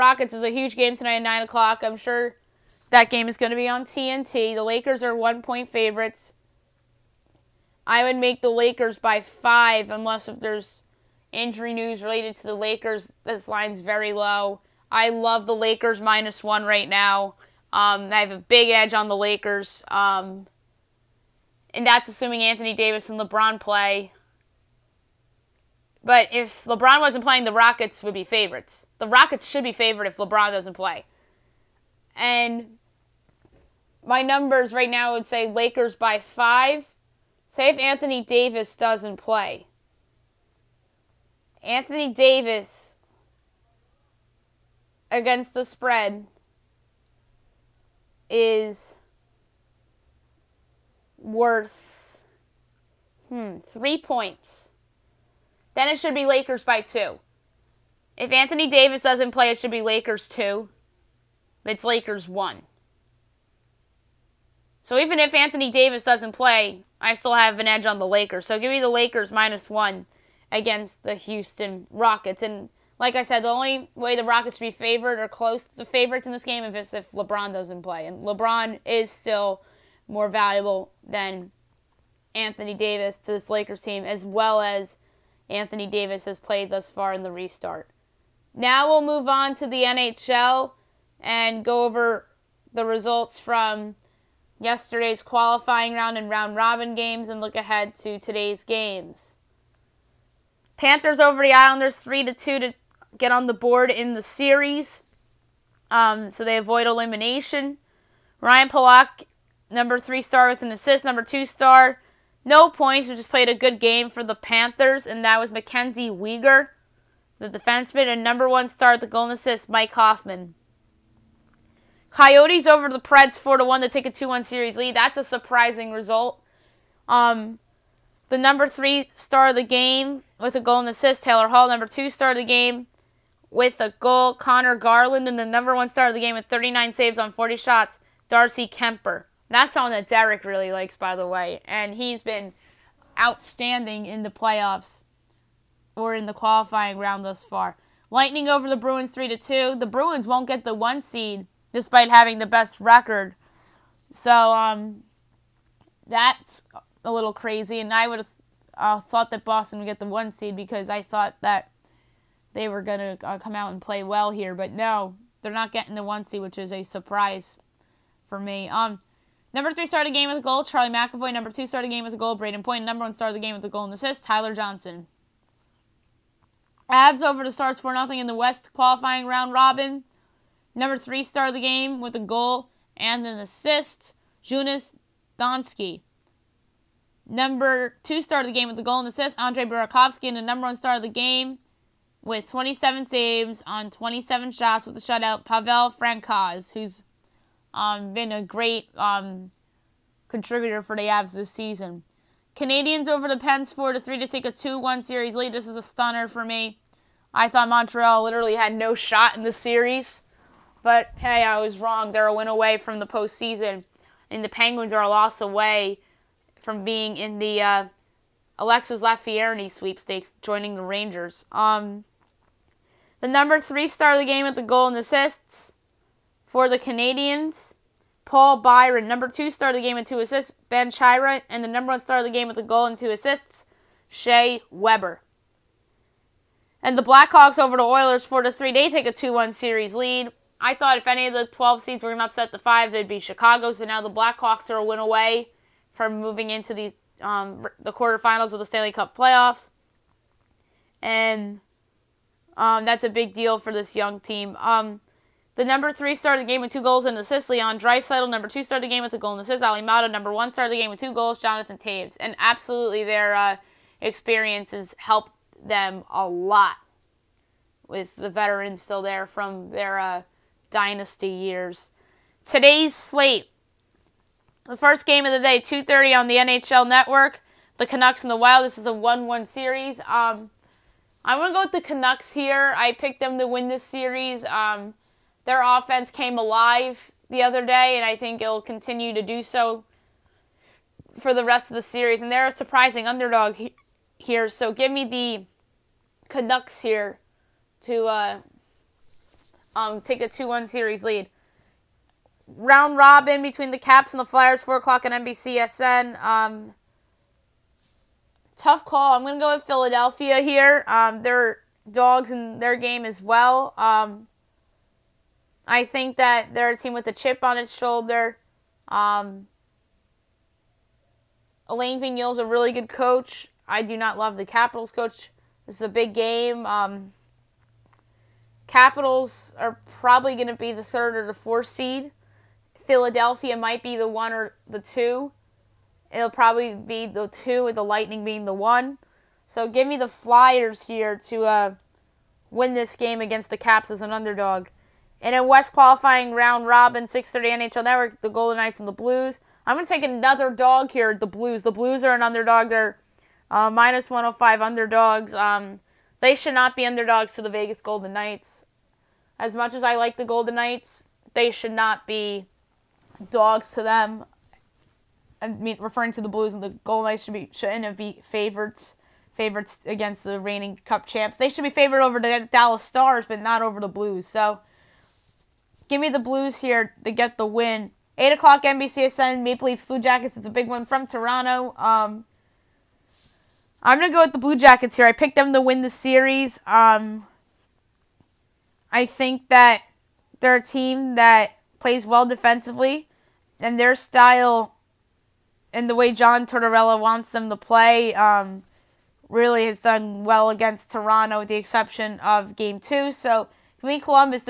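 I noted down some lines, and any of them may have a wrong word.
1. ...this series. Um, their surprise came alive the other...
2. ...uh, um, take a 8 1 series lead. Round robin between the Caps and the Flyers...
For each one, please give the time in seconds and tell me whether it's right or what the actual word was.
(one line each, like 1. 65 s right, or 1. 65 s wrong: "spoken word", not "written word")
1. 283 s wrong: "offense", not "surprise"
2. 298 s wrong: "2", not "8".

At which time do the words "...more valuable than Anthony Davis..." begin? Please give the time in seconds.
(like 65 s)
80 s.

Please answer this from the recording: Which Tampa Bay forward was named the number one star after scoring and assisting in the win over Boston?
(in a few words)
Tyler Johnson.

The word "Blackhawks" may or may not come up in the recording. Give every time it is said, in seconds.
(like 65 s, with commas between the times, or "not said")
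237 s, 244 s.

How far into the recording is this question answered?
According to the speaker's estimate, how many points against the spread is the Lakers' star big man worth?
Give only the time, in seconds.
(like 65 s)
53 s.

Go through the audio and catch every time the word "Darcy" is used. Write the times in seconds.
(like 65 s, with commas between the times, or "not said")
138 s.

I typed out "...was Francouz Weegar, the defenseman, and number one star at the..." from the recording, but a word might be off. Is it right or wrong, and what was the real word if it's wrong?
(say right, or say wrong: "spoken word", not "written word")
wrong: "Mackenzie", not "Francouz".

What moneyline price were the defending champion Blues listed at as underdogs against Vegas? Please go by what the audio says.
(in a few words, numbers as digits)
-105.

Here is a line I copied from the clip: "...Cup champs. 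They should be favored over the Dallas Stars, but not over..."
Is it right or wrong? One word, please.
right.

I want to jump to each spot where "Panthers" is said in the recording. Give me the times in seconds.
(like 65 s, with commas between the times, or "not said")
100 s, 114 s.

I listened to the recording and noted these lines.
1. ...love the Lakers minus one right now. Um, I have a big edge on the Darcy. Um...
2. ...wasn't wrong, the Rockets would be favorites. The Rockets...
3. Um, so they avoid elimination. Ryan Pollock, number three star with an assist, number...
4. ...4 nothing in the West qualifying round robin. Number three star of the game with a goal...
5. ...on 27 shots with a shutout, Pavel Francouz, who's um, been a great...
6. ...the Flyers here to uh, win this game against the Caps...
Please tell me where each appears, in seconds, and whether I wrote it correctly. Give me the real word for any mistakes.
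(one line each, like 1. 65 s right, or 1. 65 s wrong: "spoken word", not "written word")
1. 15 s wrong: "Lakers", not "Darcy"
2. 26 s wrong: "playing", not "wrong"
3. 105 s right
4. 177 s right
5. 193 s right
6. 339 s right.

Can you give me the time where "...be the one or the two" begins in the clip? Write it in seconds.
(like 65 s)
333 s.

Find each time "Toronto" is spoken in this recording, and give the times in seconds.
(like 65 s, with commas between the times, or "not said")
381 s, 400 s.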